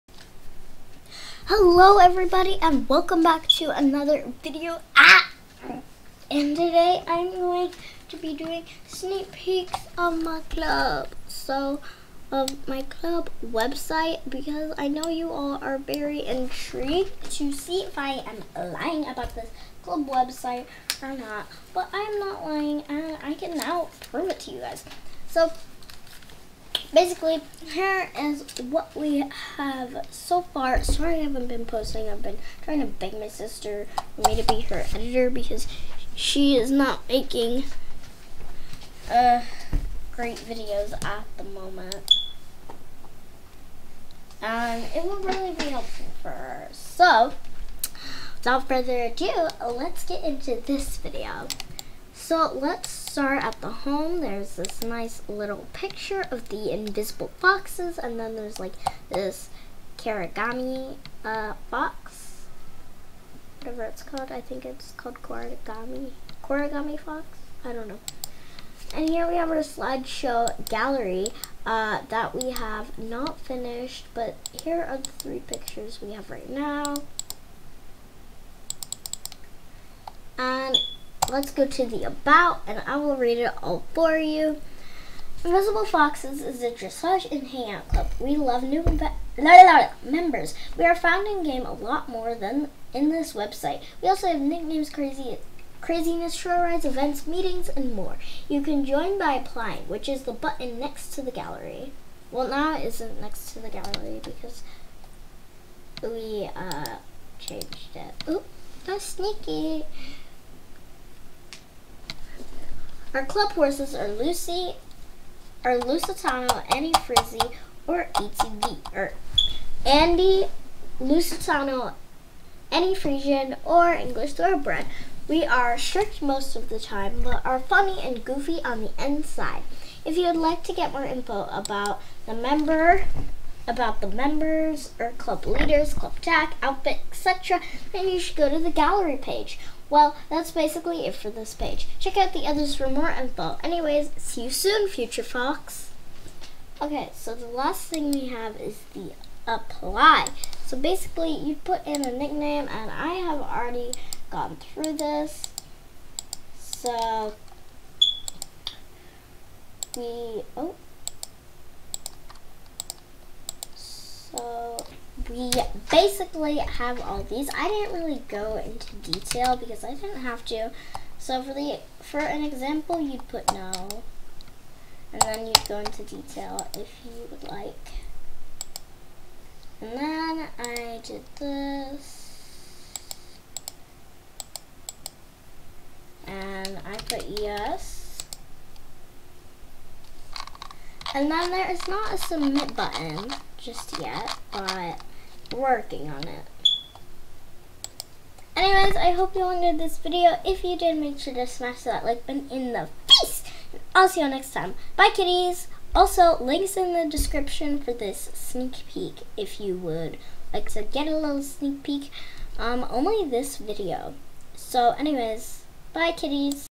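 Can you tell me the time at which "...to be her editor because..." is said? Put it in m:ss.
0:34.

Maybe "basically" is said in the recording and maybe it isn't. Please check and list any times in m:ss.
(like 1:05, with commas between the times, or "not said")
0:26, 2:20, 2:30, 2:45.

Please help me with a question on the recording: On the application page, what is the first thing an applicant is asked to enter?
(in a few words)
A nickname.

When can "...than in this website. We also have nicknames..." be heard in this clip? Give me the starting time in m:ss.
1:32.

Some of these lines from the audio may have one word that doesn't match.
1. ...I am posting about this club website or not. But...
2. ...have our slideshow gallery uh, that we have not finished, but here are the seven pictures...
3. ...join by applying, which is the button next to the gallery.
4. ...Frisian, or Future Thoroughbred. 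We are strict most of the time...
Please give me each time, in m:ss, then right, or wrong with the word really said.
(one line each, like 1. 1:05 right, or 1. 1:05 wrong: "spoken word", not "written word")
1. 0:17 wrong: "lying", not "posting"
2. 1:09 wrong: "three", not "seven"
3. 1:38 right
4. 2:02 wrong: "English", not "Future".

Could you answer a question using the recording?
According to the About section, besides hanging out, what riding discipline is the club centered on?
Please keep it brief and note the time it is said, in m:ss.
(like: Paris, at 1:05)
Dressage, at 1:26.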